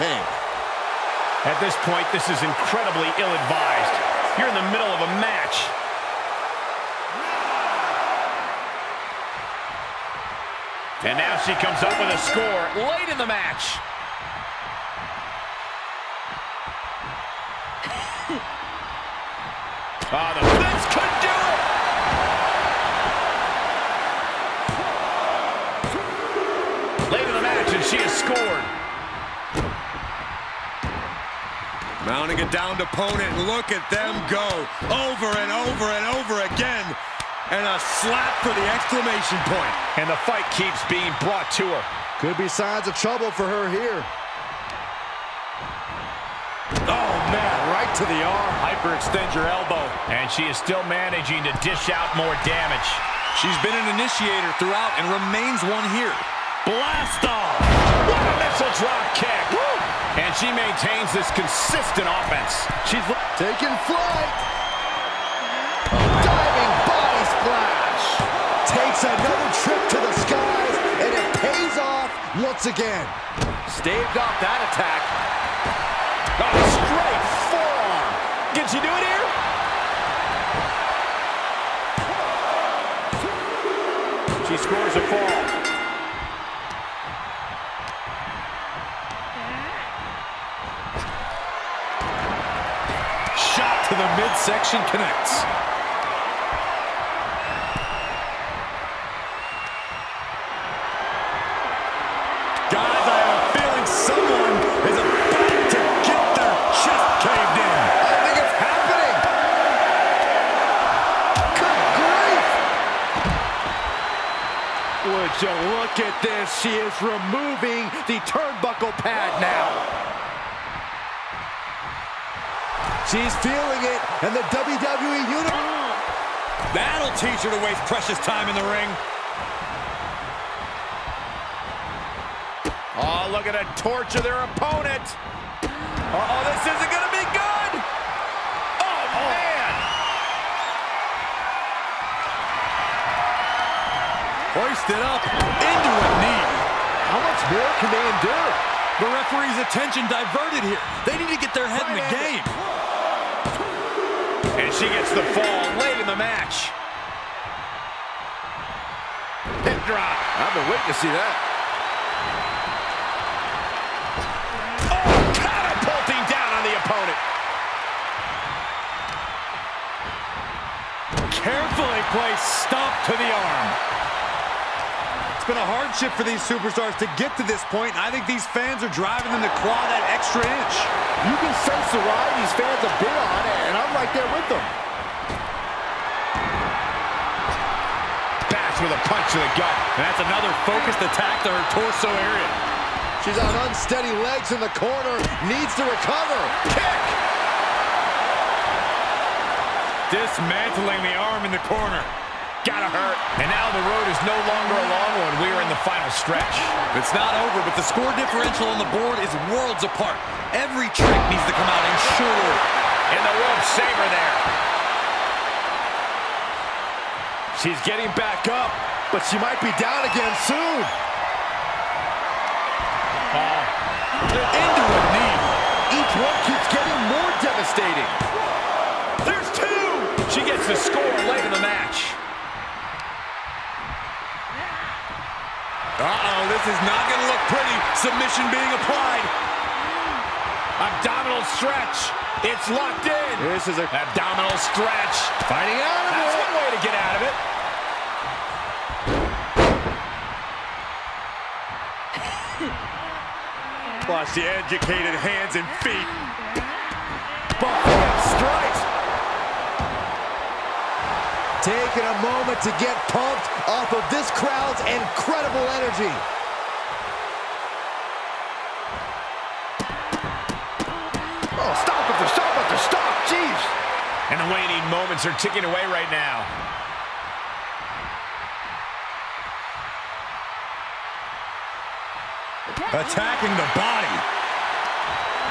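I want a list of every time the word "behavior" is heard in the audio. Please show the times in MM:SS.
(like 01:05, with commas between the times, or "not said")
not said.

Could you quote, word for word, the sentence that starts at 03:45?
Each one keeps getting more devastating.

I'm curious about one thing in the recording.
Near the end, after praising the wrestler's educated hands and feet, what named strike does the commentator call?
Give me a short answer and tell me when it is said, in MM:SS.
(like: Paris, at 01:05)
Buffalo strike, at 04:17.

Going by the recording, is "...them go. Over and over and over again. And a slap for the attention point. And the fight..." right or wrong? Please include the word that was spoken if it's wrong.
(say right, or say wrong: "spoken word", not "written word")
wrong: "exclamation", not "attention".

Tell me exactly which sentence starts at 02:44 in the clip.
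Oh, catapulting down on the opponent.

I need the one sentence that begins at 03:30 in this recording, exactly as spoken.
Every trick needs to come out in And the rope saver there.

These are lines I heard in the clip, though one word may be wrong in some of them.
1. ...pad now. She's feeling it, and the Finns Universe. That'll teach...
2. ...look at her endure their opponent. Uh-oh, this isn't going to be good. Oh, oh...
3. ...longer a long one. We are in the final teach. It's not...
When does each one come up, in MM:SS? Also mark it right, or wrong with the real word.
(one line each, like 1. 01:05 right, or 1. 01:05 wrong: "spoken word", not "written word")
1. 01:59 wrong: "WWE", not "Finns"
2. 02:13 wrong: "torture", not "endure"
3. 03:24 wrong: "stretch", not "teach".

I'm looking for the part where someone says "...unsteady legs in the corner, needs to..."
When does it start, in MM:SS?
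03:13.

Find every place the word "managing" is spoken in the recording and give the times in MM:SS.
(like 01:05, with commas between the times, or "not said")
00:50.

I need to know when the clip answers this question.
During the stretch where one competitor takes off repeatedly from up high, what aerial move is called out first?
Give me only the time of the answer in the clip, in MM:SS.
01:05.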